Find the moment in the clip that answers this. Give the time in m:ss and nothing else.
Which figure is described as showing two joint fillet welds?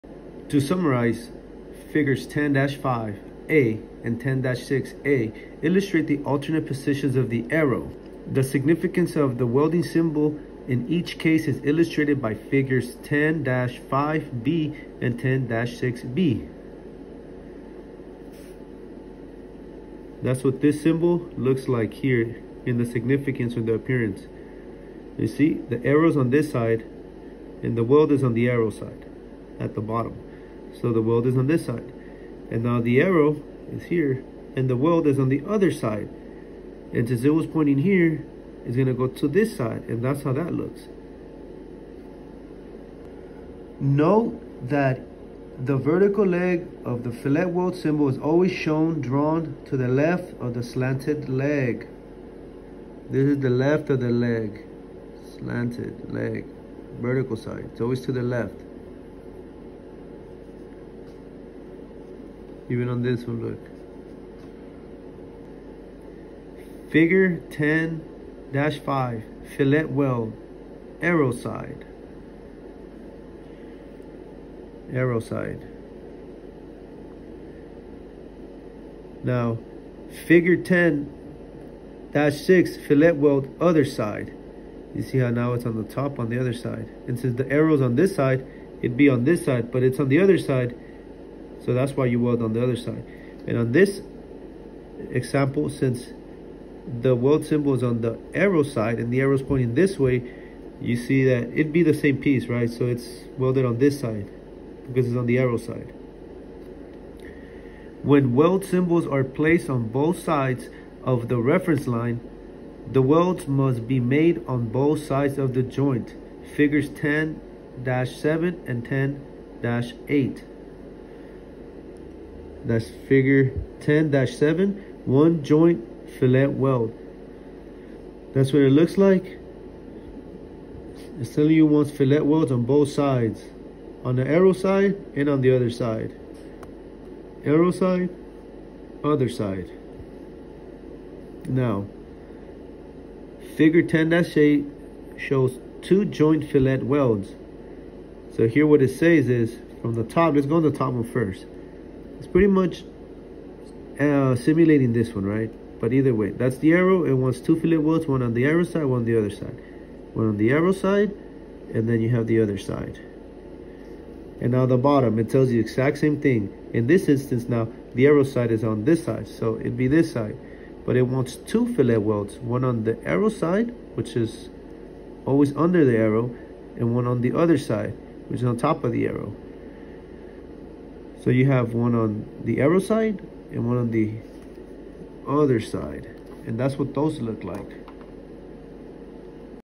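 2:23.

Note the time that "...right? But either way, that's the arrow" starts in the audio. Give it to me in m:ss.
2:35.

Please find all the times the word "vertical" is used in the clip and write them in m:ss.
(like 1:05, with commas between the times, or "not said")
0:45, 0:57.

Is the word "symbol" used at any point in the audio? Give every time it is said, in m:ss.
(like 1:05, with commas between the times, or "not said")
0:09, 0:20, 0:47, 1:37, 1:48.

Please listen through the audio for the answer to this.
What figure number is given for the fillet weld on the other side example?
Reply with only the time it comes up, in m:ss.
1:20.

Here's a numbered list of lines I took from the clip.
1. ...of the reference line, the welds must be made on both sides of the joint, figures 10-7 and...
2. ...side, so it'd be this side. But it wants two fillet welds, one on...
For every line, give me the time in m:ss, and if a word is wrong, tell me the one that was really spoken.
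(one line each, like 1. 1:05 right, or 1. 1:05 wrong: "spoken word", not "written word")
1. 1:51 right
2. 2:49 right.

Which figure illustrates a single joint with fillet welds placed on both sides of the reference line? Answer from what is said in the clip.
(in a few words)
Figure 10-7.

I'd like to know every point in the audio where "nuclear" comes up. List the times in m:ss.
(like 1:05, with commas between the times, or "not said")
not said.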